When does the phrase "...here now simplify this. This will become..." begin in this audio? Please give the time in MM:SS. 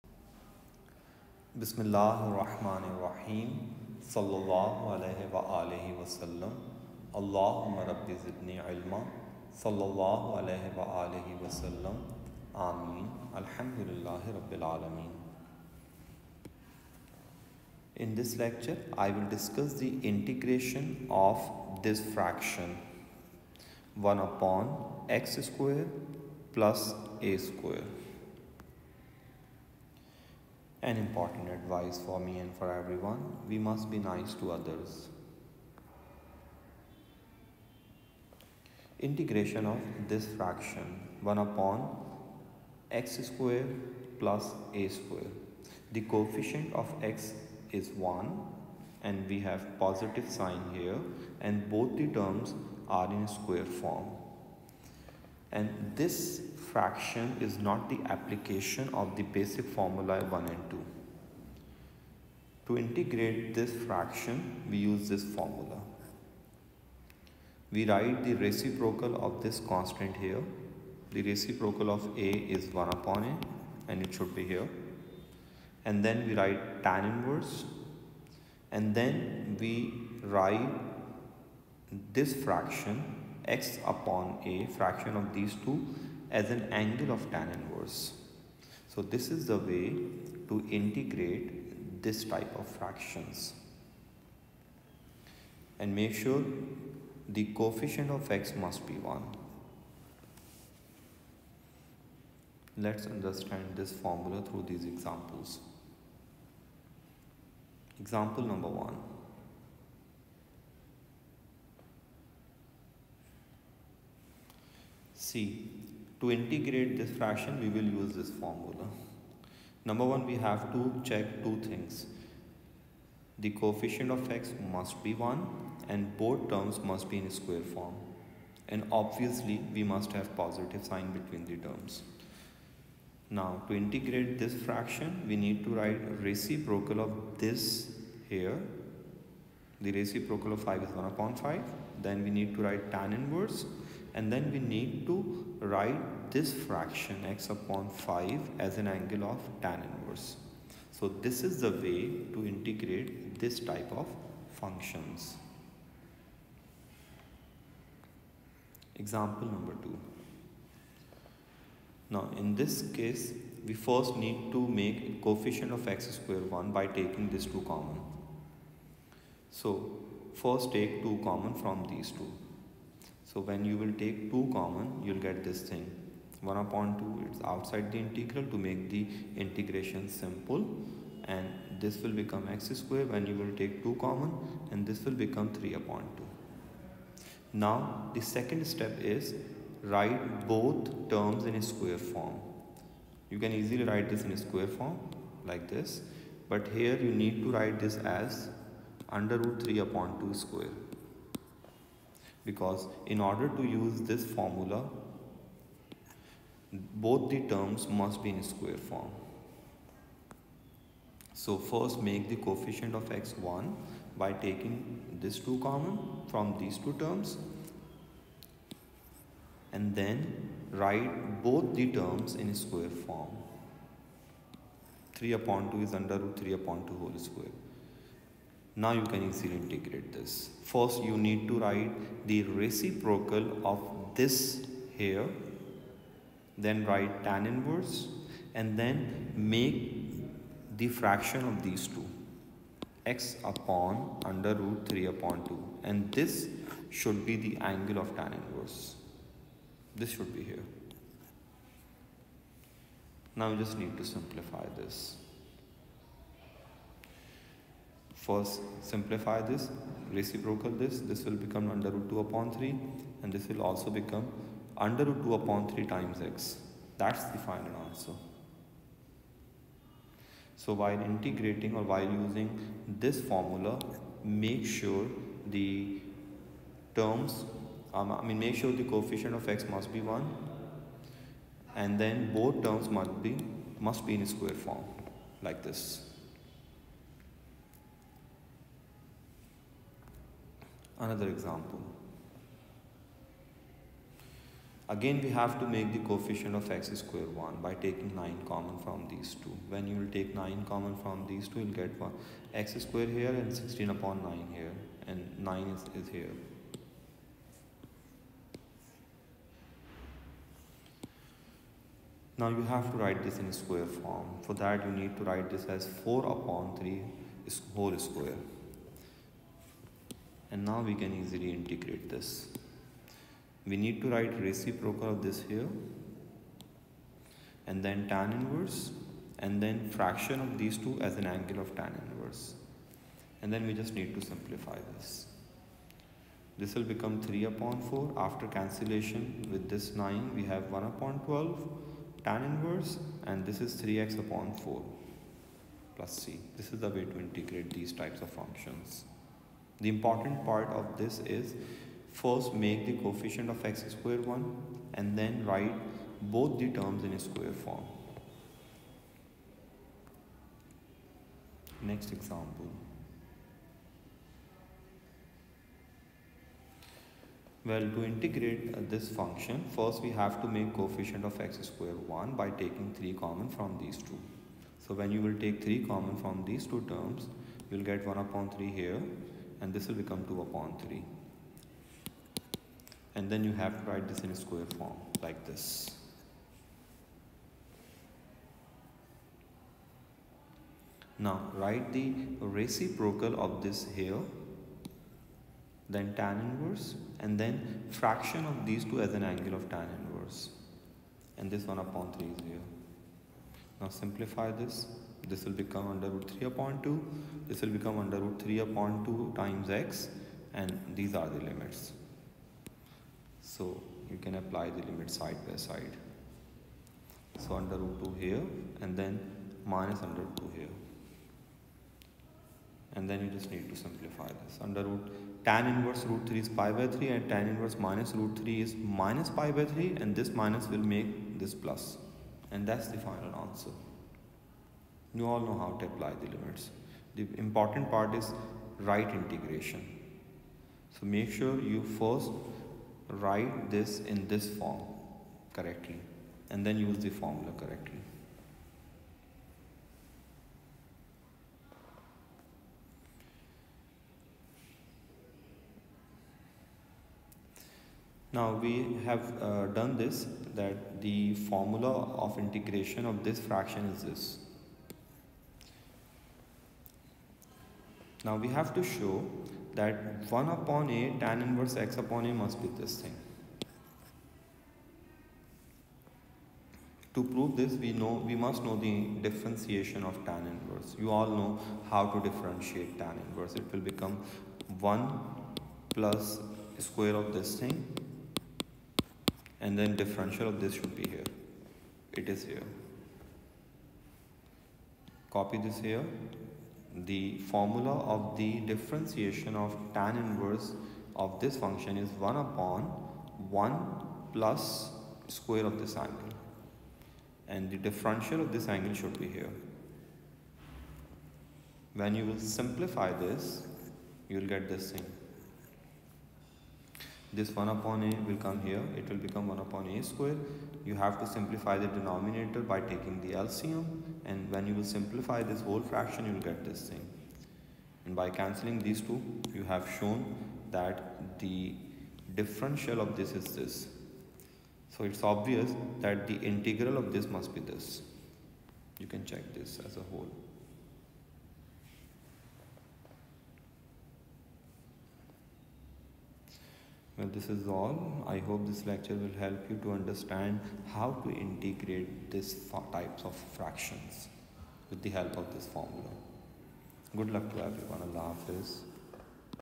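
06:42.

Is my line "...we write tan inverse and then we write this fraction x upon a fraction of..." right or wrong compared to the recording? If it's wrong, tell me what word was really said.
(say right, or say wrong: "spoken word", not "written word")
right.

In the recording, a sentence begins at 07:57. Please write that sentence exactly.
To prove this we know we must know the differentiation of tan inverse.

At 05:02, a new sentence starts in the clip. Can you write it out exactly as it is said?
x square here and 16 upon 9 here.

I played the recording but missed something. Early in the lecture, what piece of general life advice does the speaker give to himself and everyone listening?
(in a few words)
be nice to others.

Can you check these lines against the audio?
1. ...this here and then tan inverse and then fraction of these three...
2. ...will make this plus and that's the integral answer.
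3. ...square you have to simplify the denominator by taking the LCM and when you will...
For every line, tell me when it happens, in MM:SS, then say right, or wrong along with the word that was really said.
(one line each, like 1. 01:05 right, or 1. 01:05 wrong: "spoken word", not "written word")
1. 05:25 wrong: "two", not "three"
2. 07:10 wrong: "final", not "integral"
3. 08:40 right.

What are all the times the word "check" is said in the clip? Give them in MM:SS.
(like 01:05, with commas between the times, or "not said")
02:01, 08:59.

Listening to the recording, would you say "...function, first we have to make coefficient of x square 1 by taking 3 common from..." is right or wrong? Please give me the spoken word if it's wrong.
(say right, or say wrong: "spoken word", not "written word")
right.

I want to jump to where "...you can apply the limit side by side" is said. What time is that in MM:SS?
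06:54.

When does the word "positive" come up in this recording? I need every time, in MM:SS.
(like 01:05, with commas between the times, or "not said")
00:49, 02:10.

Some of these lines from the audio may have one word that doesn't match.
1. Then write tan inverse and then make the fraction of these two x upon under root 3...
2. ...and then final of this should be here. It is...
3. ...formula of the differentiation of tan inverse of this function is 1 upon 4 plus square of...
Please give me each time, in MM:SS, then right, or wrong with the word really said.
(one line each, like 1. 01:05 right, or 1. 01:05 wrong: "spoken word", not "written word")
1. 03:56 right
2. 08:09 wrong: "differential", not "final"
3. 08:17 wrong: "1", not "4".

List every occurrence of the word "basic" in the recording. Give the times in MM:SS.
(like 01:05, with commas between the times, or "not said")
00:59.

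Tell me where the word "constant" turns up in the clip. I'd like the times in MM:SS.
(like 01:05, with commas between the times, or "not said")
01:09.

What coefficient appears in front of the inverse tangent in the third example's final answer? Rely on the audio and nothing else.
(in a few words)
1/12.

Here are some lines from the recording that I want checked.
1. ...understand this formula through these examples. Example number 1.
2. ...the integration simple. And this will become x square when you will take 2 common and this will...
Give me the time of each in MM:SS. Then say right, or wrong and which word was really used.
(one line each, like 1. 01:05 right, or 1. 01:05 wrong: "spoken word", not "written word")
1. 01:43 right
2. 02:58 right.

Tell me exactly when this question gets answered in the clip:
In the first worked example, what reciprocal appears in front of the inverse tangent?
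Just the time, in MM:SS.
02:20.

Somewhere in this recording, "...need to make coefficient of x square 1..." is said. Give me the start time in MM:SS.
02:44.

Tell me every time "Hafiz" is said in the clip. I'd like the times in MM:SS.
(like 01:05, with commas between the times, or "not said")
09:18.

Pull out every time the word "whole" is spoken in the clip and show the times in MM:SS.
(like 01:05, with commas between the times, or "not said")
03:47, 05:17, 08:45, 09:00.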